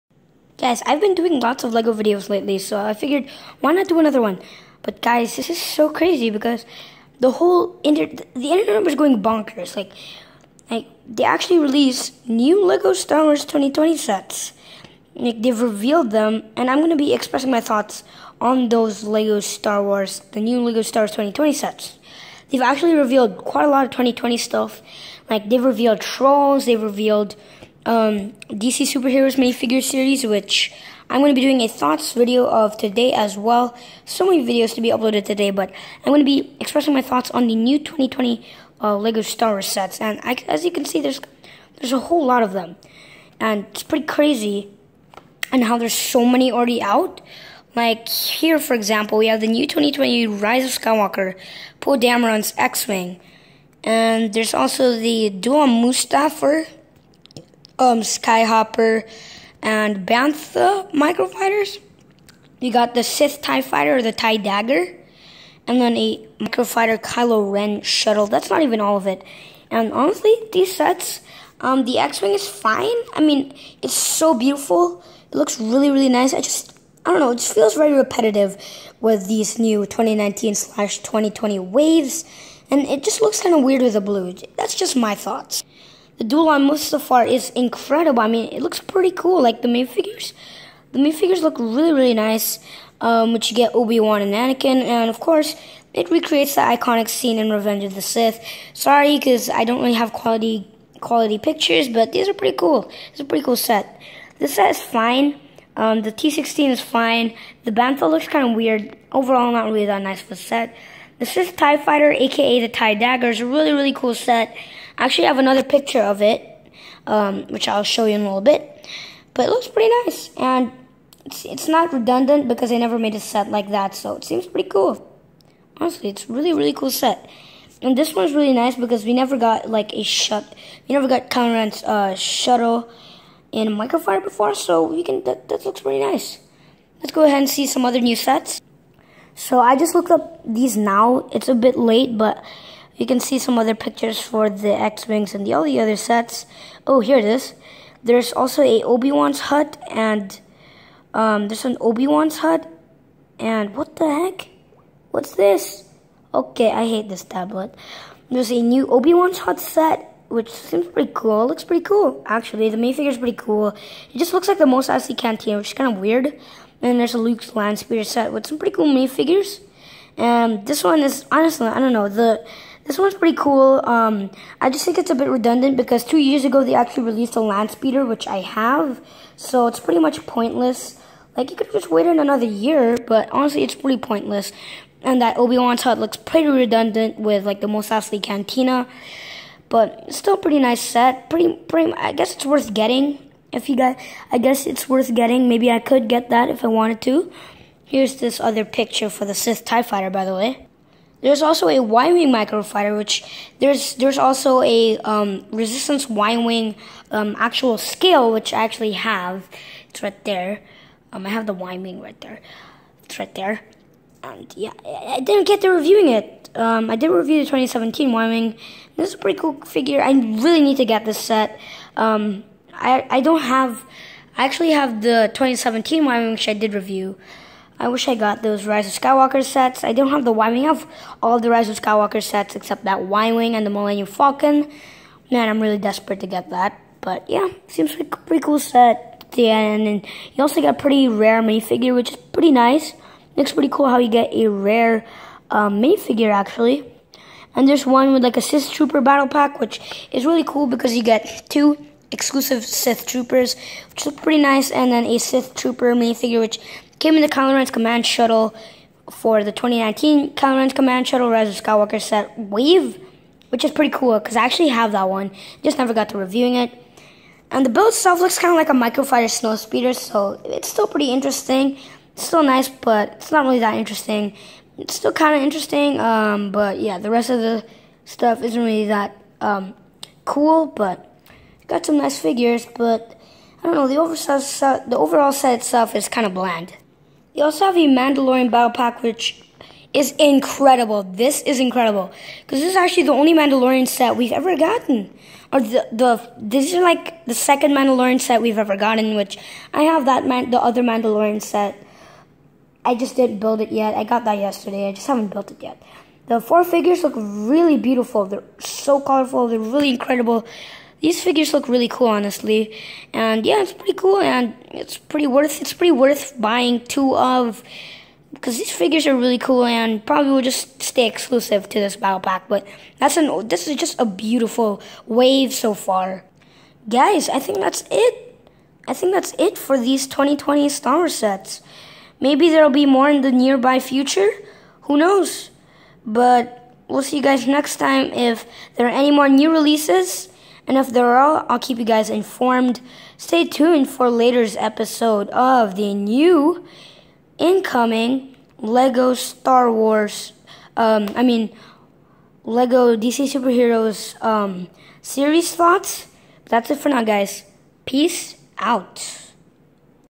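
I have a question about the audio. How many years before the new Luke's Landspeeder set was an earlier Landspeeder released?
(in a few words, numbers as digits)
2.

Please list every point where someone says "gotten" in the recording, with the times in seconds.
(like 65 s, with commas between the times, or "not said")
294 s, 298 s.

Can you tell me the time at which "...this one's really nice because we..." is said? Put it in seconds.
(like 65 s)
127 s.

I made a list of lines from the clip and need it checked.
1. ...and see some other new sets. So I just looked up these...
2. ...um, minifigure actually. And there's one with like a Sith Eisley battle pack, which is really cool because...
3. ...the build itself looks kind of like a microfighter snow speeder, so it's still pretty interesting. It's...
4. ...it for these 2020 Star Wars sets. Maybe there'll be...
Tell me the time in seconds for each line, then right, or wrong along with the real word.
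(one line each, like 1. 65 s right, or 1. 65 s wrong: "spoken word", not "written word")
1. 137 s right
2. 245 s wrong: "Trooper", not "Eisley"
3. 267 s right
4. 329 s right.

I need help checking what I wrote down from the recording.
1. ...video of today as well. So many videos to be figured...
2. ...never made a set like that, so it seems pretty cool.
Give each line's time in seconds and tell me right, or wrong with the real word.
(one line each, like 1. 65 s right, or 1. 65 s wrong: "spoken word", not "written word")
1. 32 s wrong: "uploaded", not "figured"
2. 122 s right.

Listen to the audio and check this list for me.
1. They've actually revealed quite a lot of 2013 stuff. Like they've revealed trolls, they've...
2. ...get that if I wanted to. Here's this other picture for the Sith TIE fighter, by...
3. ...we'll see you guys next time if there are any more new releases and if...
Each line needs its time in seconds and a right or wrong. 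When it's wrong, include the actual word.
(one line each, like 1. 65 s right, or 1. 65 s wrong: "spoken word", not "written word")
1. 22 s wrong: "2020", not "2013"
2. 196 s right
3. 336 s right.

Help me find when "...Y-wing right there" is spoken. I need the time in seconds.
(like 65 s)
211 s.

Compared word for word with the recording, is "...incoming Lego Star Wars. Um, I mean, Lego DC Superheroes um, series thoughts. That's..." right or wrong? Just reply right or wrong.
right.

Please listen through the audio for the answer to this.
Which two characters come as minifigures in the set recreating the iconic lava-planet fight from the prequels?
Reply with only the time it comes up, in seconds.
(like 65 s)
93 s.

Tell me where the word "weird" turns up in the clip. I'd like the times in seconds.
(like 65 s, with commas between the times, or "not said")
83 s, 108 s, 165 s.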